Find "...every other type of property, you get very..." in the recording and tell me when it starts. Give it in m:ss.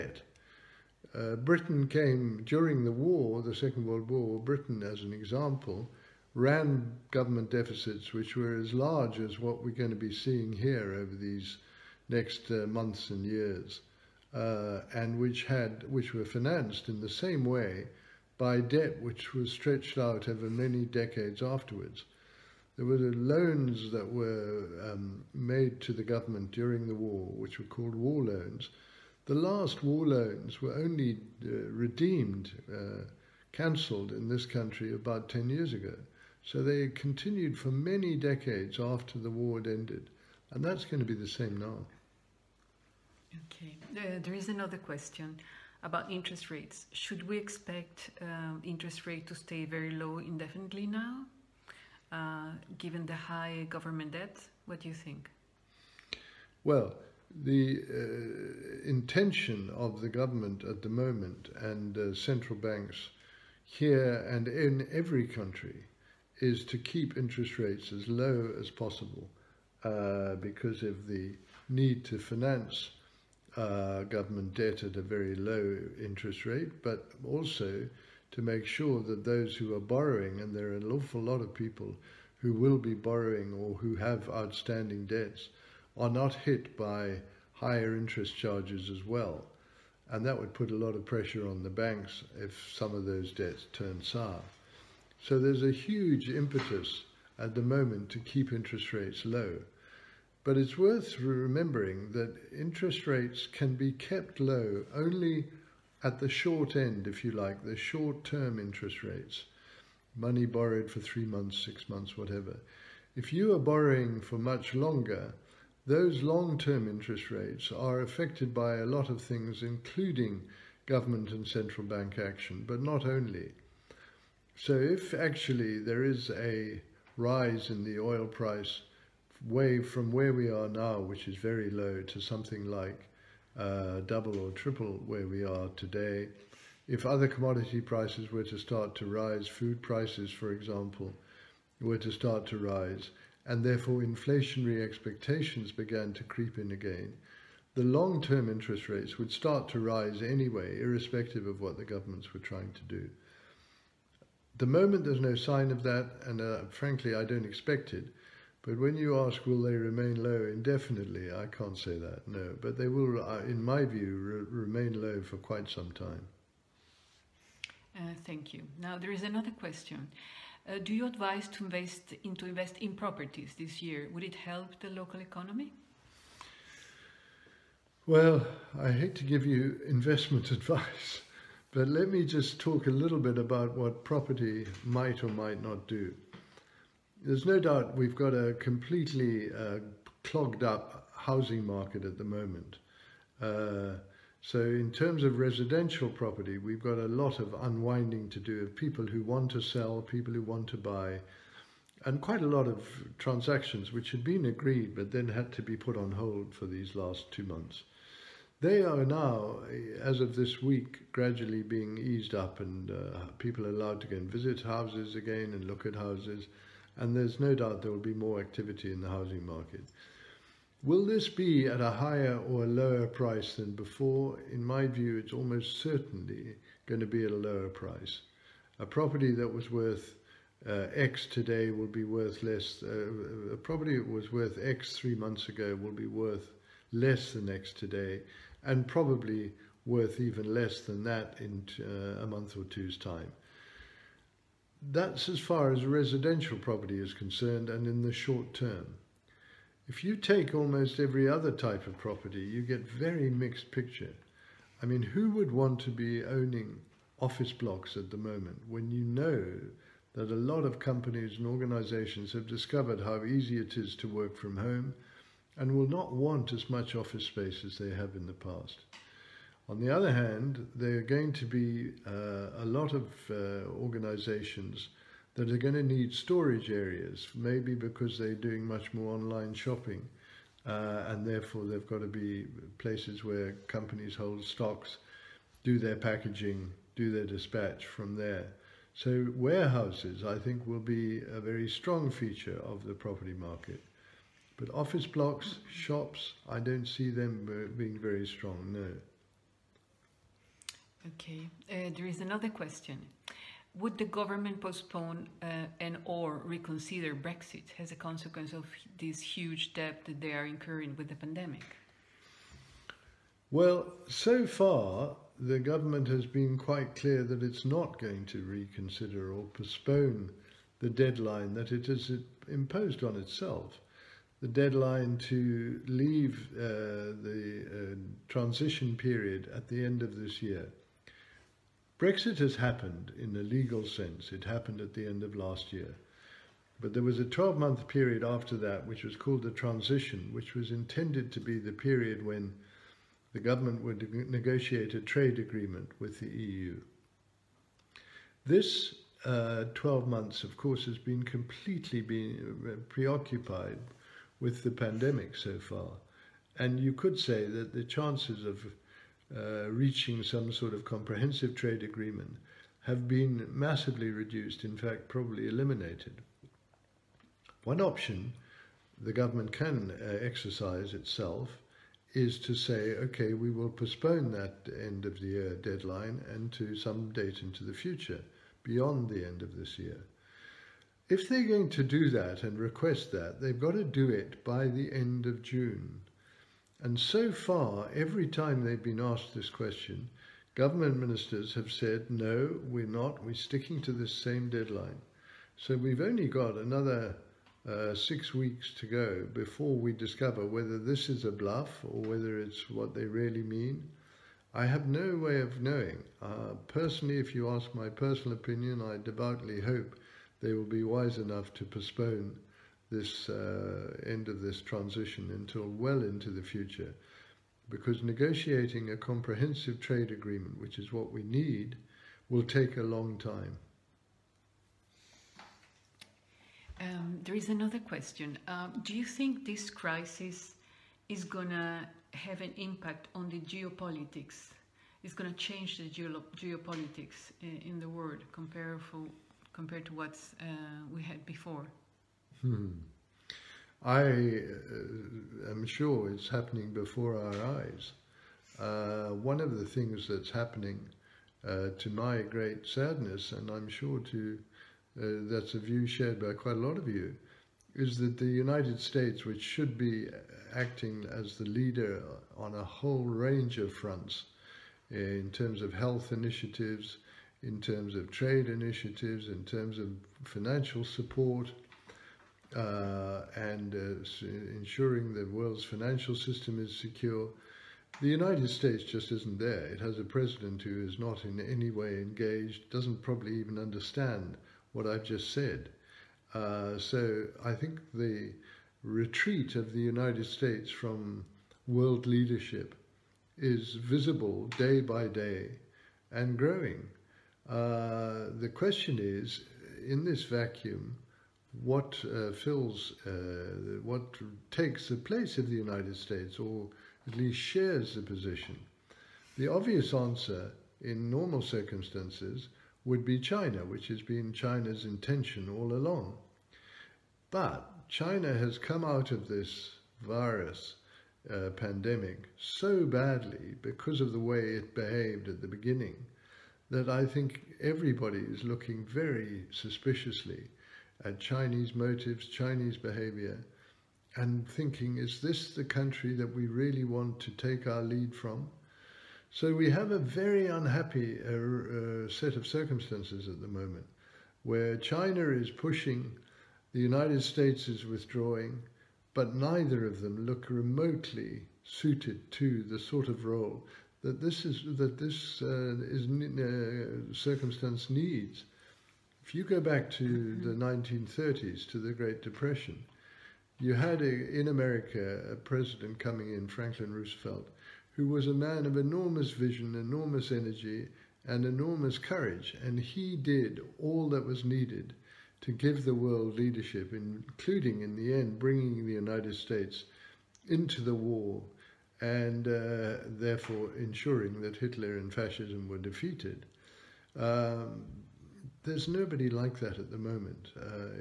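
4:10.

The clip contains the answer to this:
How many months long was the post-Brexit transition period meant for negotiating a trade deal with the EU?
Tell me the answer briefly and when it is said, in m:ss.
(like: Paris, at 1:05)
12, at 5:37.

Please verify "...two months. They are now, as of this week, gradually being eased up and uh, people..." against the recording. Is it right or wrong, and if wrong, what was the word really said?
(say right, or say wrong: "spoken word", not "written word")
right.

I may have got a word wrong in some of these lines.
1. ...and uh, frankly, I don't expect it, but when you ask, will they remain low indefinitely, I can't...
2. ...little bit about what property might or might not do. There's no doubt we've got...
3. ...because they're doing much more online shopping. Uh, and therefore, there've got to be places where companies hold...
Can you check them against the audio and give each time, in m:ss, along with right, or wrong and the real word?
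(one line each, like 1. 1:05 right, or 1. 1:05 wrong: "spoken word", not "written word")
1. 2:36 right
2. 3:02 right
3. 4:37 right.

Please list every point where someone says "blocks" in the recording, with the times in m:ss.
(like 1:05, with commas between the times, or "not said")
4:17, 4:55.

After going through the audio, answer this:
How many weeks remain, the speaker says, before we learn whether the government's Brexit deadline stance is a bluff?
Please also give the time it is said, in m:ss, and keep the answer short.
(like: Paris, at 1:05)
6, at 6:37.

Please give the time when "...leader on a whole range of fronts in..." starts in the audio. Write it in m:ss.
7:41.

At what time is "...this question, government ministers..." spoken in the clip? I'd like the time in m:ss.
6:29.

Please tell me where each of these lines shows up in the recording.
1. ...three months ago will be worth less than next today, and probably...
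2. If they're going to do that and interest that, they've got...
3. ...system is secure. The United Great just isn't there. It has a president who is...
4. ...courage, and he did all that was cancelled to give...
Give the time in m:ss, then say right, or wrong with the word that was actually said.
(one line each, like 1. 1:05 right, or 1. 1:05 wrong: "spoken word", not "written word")
1. 3:54 right
2. 6:21 wrong: "request", not "interest"
3. 7:56 wrong: "States", not "Great"
4. 9:31 wrong: "needed", not "cancelled".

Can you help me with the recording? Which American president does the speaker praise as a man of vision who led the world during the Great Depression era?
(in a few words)
Franklin Roosevelt.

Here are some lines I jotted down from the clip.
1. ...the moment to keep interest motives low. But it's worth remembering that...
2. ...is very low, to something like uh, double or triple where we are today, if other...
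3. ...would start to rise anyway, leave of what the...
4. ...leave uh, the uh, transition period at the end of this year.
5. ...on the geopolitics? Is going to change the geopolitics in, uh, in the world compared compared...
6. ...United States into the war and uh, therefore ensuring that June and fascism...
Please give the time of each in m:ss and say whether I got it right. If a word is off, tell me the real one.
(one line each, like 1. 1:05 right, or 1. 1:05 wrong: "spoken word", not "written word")
1. 1:37 wrong: "rates", not "motives"
2. 2:11 right
3. 2:29 wrong: "irrespective", not "leave"
4. 5:25 right
5. 7:13 right
6. 9:38 wrong: "Hitler", not "June".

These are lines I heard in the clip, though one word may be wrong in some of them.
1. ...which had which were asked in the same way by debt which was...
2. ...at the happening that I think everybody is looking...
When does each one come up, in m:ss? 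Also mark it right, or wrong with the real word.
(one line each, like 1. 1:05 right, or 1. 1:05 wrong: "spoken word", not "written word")
1. 0:15 wrong: "financed", not "asked"
2. 8:45 wrong: "beginning", not "happening".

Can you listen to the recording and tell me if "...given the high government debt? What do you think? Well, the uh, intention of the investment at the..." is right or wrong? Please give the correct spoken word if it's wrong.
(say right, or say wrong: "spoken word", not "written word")
wrong: "government", not "investment".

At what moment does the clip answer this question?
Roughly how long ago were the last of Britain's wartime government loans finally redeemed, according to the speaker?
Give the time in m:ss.
0:34.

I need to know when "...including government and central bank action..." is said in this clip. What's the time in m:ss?
1:59.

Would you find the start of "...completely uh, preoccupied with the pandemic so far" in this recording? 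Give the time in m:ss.
5:51.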